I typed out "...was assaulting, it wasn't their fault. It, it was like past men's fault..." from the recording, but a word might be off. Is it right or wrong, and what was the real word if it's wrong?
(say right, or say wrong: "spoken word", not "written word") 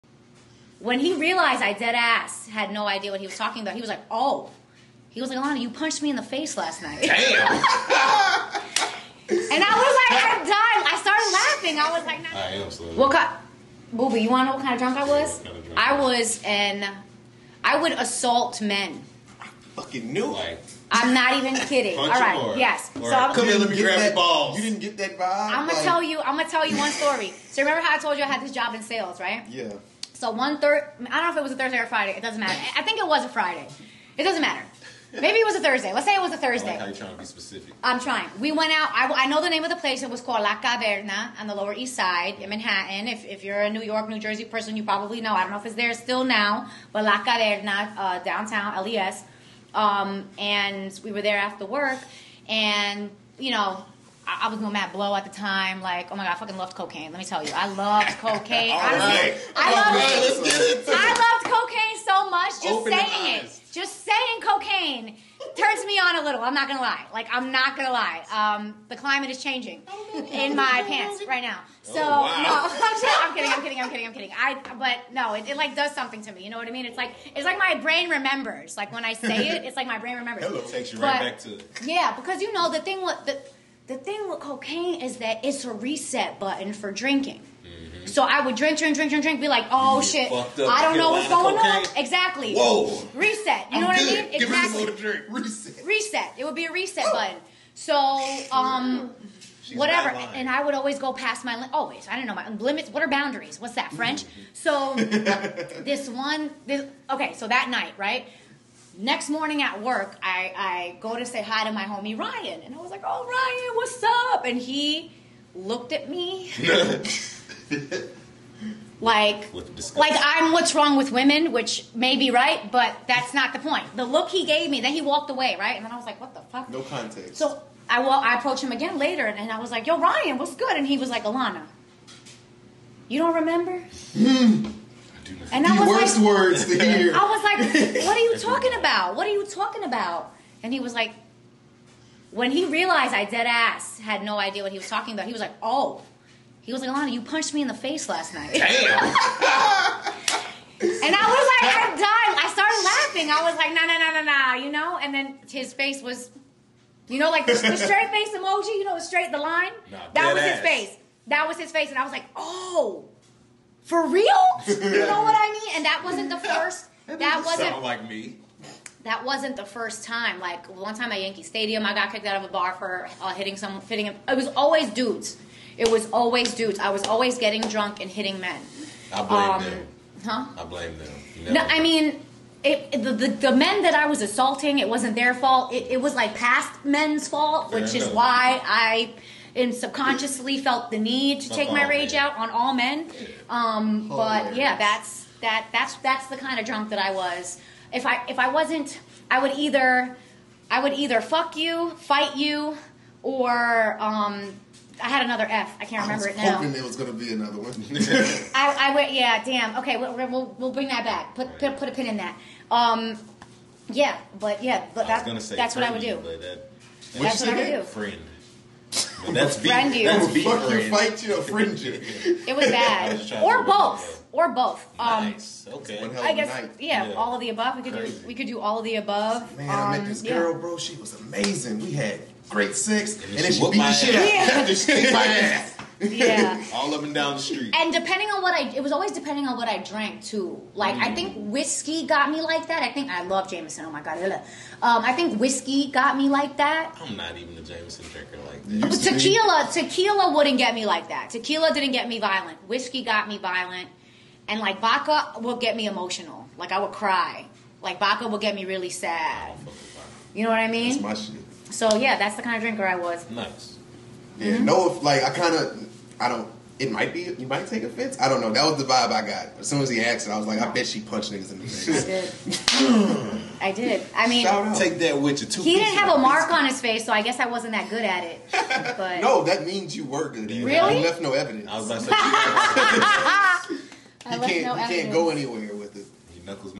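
right.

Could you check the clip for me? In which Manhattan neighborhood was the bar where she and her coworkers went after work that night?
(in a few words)
Lower East Side.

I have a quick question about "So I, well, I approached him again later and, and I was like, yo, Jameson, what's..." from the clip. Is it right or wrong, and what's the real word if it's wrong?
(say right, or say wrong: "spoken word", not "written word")
wrong: "Ryan", not "Jameson".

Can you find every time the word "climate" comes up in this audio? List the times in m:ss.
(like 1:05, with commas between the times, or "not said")
1:08.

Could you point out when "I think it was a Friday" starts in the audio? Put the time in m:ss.
0:32.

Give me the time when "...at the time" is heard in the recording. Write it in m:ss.
0:55.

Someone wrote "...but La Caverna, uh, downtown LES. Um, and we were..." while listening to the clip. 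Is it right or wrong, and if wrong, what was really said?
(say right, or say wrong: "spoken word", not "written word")
right.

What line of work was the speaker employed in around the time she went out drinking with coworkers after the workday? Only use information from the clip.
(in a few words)
Sales.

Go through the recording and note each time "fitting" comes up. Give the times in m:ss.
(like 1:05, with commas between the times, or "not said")
2:53.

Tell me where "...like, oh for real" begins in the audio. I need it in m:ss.
2:42.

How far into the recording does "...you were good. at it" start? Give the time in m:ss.
4:39.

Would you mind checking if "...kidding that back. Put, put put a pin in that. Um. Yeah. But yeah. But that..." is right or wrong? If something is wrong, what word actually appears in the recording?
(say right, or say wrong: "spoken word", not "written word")
wrong: "bring", not "kidding".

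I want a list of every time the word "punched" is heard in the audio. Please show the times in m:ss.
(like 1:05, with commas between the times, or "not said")
0:05, 2:27, 4:31.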